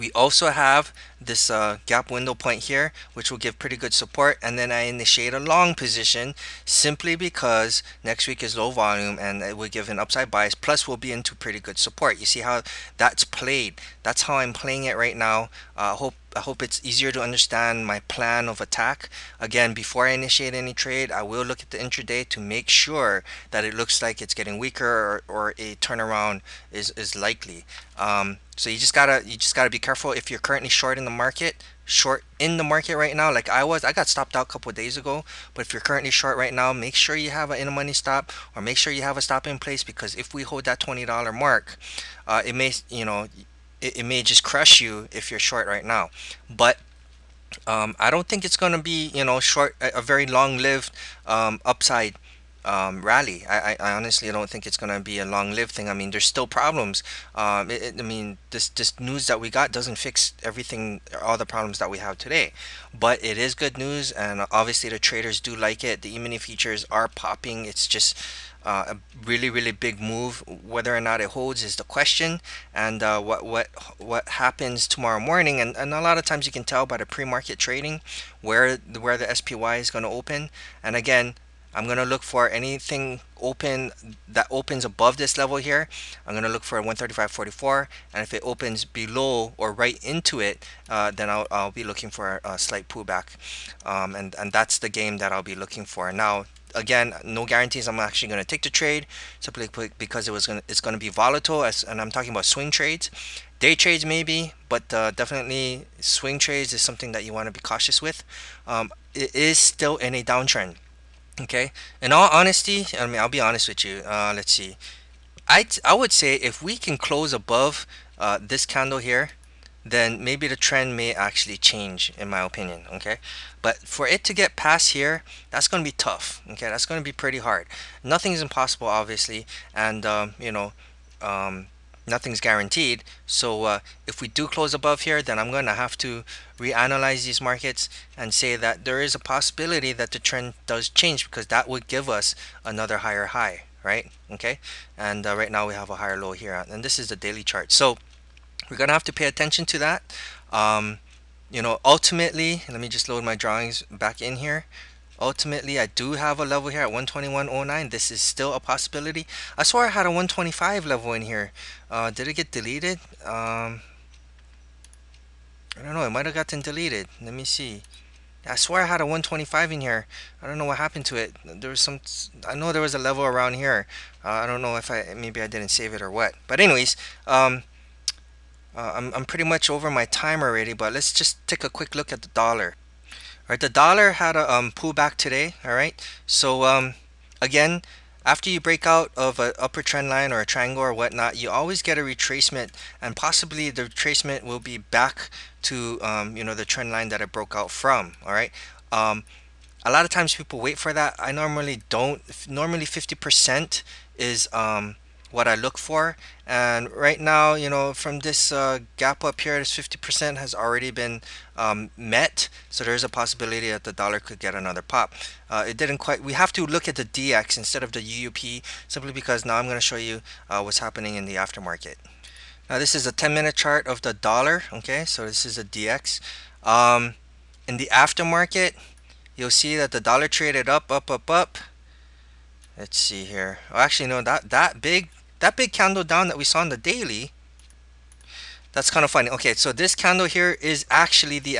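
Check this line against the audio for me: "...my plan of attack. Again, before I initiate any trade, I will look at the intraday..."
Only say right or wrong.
right.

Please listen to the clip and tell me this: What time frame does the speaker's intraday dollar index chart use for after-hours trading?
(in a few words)
10 minute.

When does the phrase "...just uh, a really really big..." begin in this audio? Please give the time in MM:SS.
01:07.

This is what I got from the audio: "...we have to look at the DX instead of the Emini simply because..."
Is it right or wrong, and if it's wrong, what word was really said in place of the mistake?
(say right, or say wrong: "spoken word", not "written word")
wrong: "UUP", not "Emini".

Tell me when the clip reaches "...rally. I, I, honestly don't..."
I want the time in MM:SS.
00:53.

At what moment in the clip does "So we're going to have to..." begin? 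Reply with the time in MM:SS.
02:27.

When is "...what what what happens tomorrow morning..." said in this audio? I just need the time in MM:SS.
01:13.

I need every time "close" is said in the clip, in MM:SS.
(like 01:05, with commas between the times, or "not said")
01:56, 02:14.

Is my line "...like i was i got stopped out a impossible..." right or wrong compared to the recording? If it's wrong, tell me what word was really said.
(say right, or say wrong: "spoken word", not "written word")
wrong: "couple", not "impossible".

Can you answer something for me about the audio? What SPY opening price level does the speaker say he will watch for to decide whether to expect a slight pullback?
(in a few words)
135.44.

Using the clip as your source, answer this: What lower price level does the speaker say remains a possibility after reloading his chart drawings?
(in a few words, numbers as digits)
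121.09.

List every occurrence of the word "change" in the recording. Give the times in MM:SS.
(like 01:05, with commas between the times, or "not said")
02:01, 02:20.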